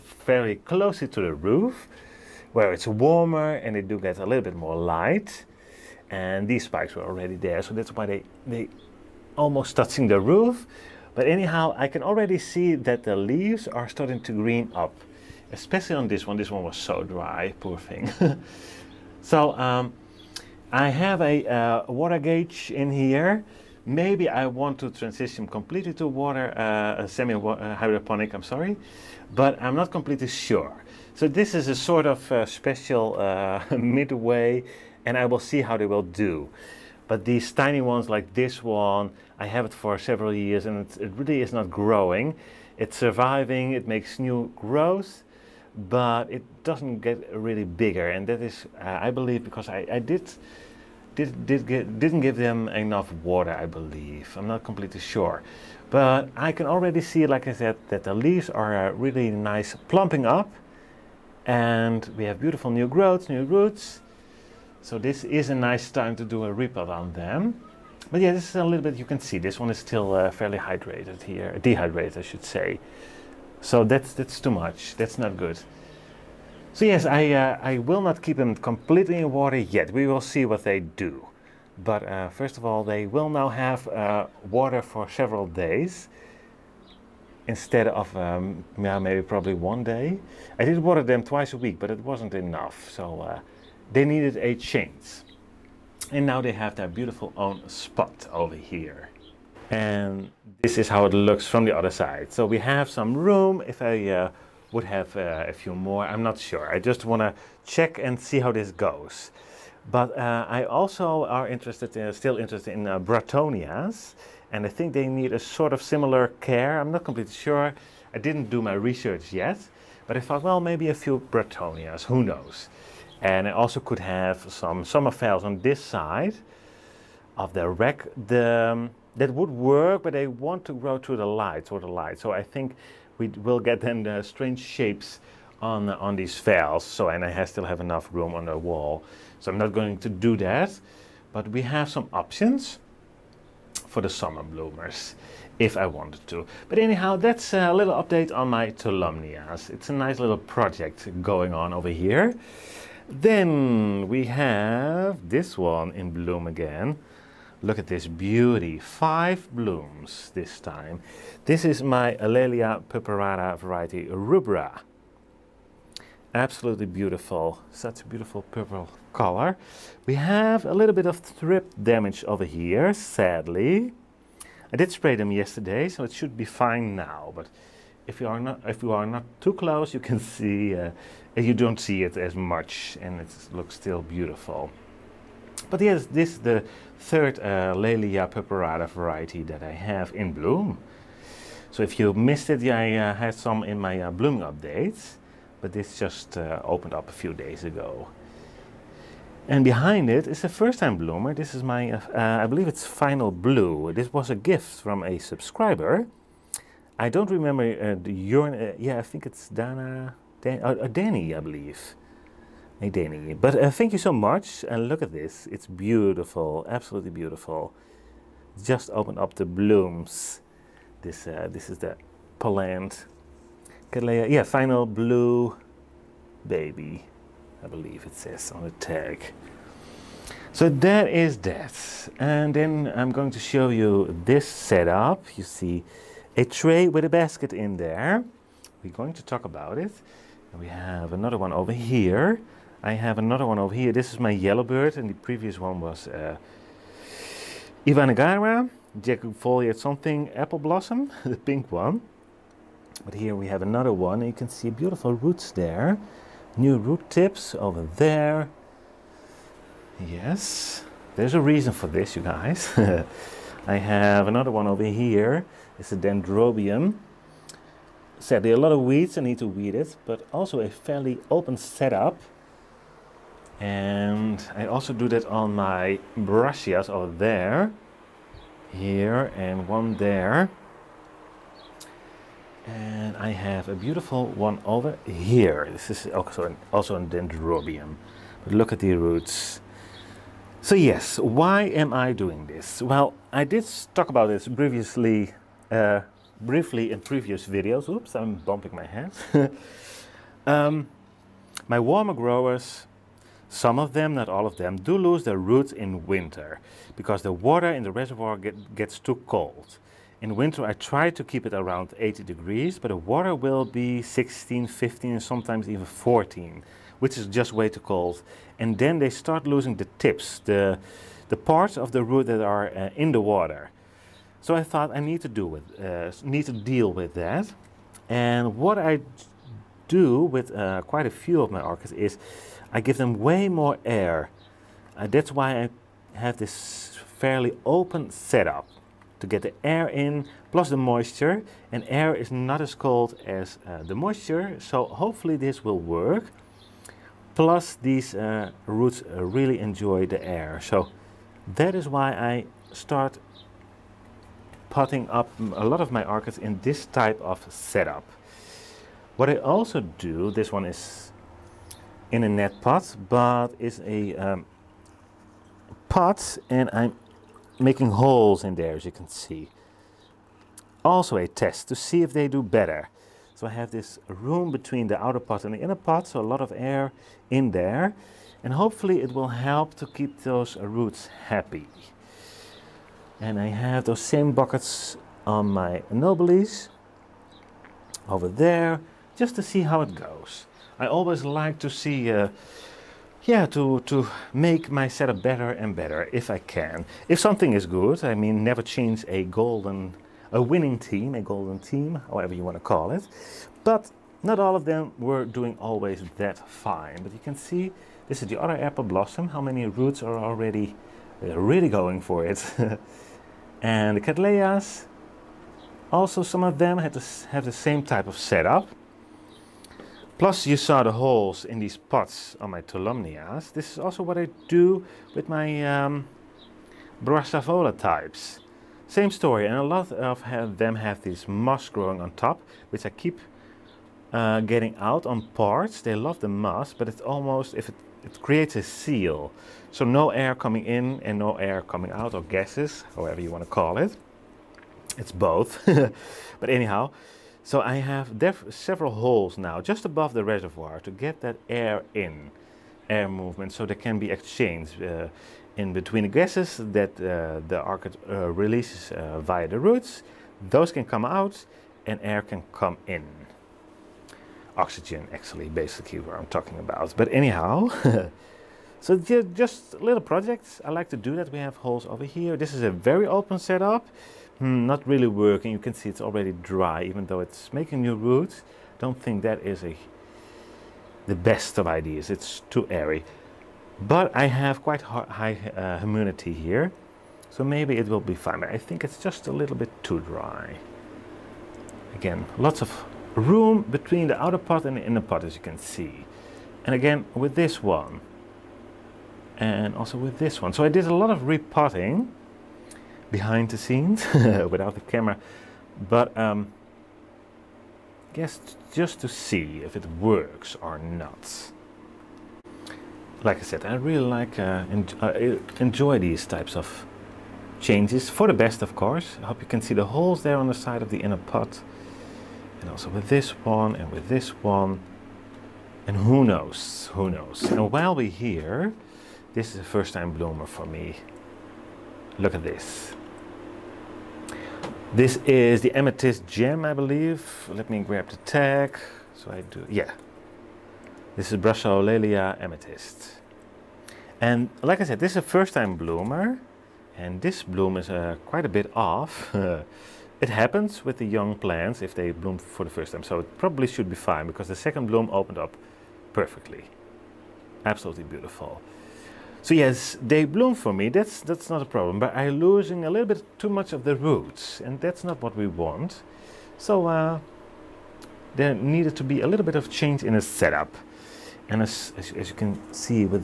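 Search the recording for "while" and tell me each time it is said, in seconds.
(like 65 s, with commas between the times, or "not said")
527 s.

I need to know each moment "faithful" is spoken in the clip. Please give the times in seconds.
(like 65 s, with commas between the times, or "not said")
not said.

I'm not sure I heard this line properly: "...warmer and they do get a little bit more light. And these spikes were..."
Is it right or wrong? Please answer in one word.
right.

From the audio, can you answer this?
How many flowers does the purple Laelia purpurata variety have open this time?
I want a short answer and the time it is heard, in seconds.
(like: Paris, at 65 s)
5, at 158 s.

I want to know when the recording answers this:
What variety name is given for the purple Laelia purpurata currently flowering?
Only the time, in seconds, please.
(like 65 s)
164 s.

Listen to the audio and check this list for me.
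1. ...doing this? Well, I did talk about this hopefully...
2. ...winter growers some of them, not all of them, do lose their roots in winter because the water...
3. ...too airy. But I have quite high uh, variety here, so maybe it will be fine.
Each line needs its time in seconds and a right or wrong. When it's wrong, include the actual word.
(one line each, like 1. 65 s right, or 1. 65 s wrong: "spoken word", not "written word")
1. 292 s wrong: "previously", not "hopefully"
2. 301 s wrong: "warmer", not "winter"
3. 482 s wrong: "humidity", not "variety".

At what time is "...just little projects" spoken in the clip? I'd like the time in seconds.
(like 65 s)
469 s.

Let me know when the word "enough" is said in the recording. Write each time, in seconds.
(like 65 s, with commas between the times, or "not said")
52 s, 92 s, 137 s.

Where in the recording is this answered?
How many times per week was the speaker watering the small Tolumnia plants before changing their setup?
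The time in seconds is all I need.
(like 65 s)
91 s.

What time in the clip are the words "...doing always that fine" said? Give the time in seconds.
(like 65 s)
405 s.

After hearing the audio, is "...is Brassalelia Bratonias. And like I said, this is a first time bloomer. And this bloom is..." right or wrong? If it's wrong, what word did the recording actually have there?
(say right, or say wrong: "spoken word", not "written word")
wrong: "Amethyst", not "Bratonias".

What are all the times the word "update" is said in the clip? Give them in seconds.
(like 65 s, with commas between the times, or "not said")
147 s, 194 s.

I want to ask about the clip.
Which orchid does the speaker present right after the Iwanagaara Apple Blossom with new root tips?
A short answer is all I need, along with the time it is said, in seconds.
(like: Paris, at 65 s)
Yellow Bird, at 244 s.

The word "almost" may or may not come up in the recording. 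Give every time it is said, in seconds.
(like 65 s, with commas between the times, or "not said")
9 s, 437 s.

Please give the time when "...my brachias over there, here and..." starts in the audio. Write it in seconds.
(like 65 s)
275 s.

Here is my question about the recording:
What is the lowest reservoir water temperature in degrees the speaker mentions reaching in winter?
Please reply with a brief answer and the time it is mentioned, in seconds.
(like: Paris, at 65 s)
14, at 315 s.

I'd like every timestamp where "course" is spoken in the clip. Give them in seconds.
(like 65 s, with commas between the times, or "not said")
518 s.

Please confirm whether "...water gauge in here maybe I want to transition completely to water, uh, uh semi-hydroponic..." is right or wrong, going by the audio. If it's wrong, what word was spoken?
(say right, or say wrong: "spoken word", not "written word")
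right.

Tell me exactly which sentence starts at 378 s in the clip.
And hopefully it will help to keep those roots happy.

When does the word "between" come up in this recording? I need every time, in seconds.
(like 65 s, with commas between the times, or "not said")
374 s, 455 s, 493 s.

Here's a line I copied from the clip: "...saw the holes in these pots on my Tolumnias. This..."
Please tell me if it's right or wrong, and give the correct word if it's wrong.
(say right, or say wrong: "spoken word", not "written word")
right.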